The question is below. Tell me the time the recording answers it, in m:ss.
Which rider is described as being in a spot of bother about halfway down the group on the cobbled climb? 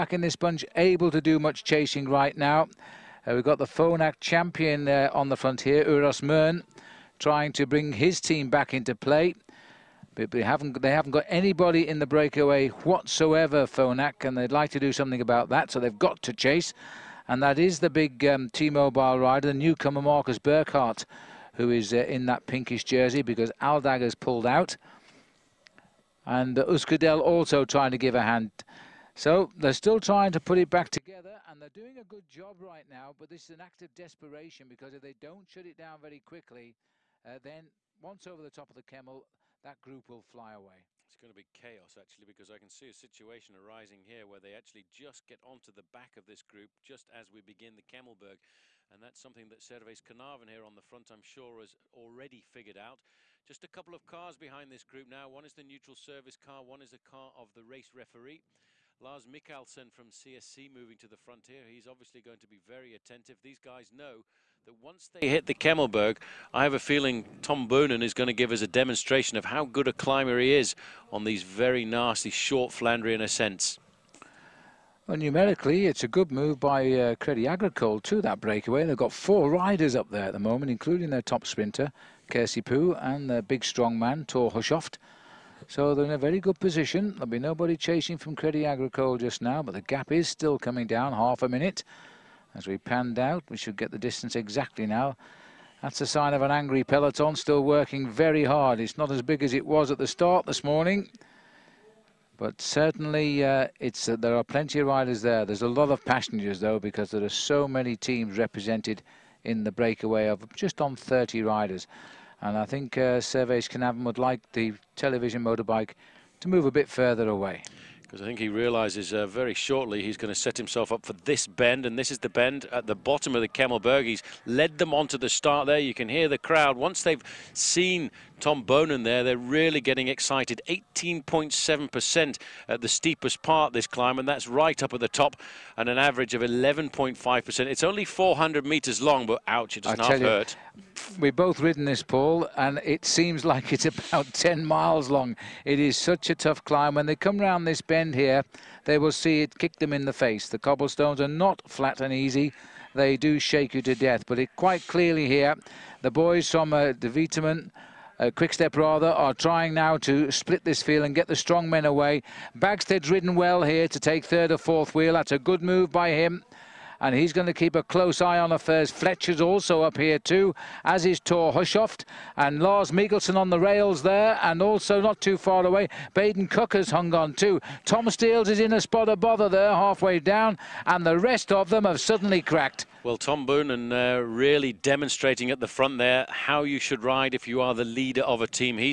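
2:57.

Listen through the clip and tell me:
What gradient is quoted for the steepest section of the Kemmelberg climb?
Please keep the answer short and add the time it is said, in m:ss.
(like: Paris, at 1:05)
18.7%, at 2:10.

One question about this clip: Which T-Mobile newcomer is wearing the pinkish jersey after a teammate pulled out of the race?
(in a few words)
Marcus Burghardt.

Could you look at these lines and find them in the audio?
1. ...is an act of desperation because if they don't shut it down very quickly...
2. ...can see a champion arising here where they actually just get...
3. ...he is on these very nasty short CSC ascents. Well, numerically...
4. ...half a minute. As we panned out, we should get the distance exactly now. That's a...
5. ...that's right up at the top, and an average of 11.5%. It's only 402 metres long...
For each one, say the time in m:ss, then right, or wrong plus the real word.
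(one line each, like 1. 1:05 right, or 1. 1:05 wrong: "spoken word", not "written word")
1. 0:33 right
2. 0:42 wrong: "situation", not "champion"
3. 1:10 wrong: "Flandrian", not "CSC"
4. 1:31 right
5. 2:14 wrong: "400", not "402".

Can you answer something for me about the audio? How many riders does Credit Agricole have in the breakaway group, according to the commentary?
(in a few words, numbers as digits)
4.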